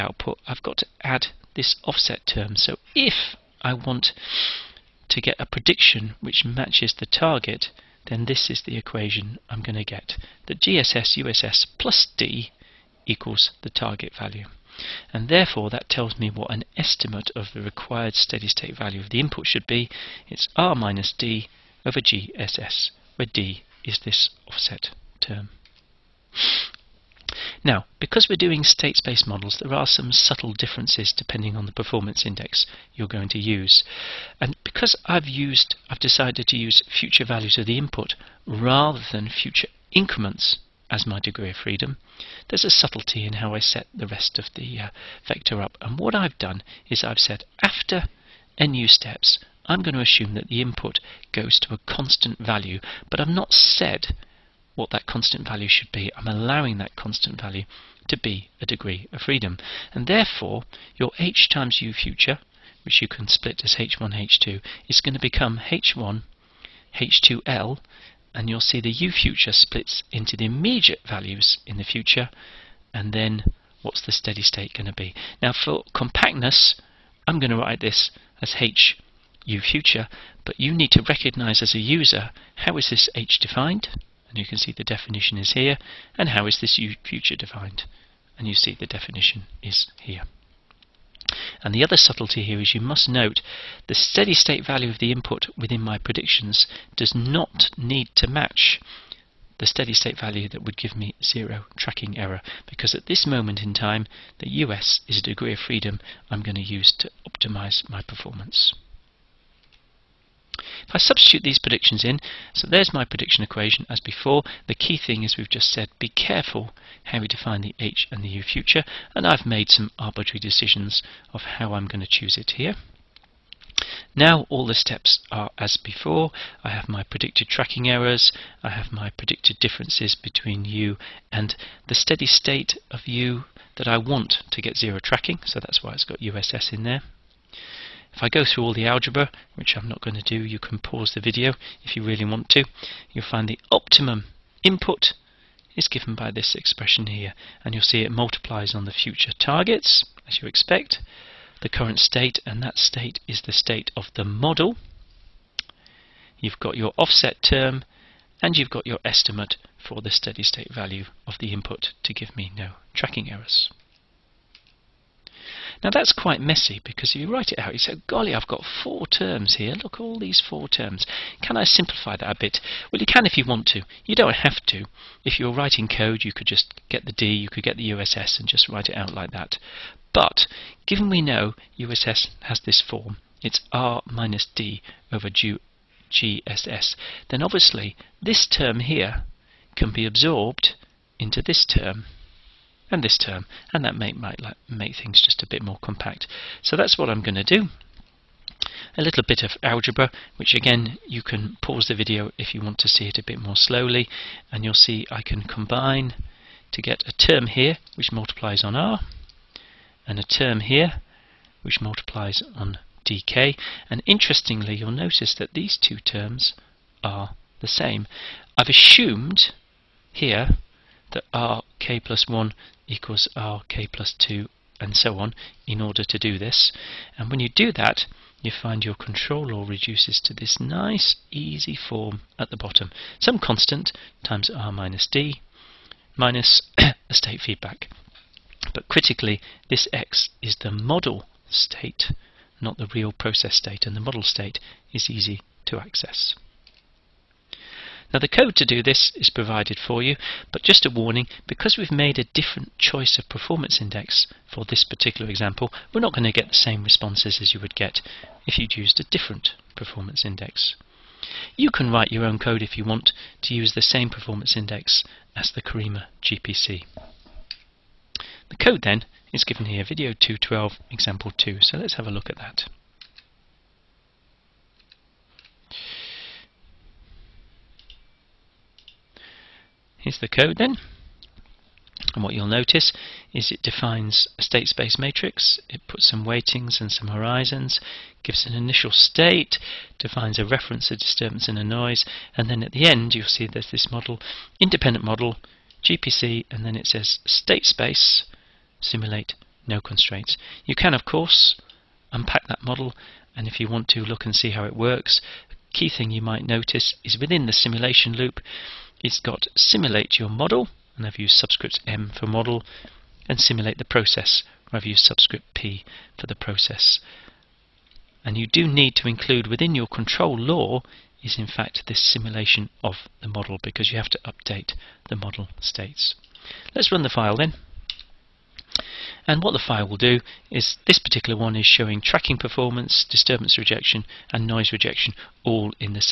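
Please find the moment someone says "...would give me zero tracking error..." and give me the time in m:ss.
1:40.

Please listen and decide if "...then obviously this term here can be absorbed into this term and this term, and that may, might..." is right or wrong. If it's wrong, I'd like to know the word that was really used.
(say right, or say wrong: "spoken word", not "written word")
right.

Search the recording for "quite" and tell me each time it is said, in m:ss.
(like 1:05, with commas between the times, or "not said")
2:46.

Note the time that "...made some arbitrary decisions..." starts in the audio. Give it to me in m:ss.
1:59.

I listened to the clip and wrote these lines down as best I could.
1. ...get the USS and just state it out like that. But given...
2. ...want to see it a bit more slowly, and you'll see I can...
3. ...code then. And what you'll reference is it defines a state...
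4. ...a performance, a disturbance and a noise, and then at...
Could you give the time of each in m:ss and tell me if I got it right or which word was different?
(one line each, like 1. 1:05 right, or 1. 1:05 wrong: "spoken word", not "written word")
1. 2:57 wrong: "write", not "state"
2. 3:22 right
3. 4:40 wrong: "notice", not "reference"
4. 4:50 wrong: "reference", not "performance".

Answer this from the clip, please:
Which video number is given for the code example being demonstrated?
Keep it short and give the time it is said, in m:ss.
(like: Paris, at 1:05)
212, at 4:29.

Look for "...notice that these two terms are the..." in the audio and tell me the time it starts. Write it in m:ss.
3:34.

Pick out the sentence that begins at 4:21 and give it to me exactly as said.
You can write your own code if you want to use the same performance index as the CARIMA GPC.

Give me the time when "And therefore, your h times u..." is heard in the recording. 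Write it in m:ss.
0:59.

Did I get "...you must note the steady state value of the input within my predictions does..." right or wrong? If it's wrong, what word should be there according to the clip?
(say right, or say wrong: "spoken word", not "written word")
right.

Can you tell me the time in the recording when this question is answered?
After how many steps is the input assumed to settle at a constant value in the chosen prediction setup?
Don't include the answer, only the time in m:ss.
0:48.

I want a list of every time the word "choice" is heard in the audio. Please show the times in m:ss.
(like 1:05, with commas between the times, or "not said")
4:12.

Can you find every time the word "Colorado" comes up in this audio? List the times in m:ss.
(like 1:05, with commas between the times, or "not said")
not said.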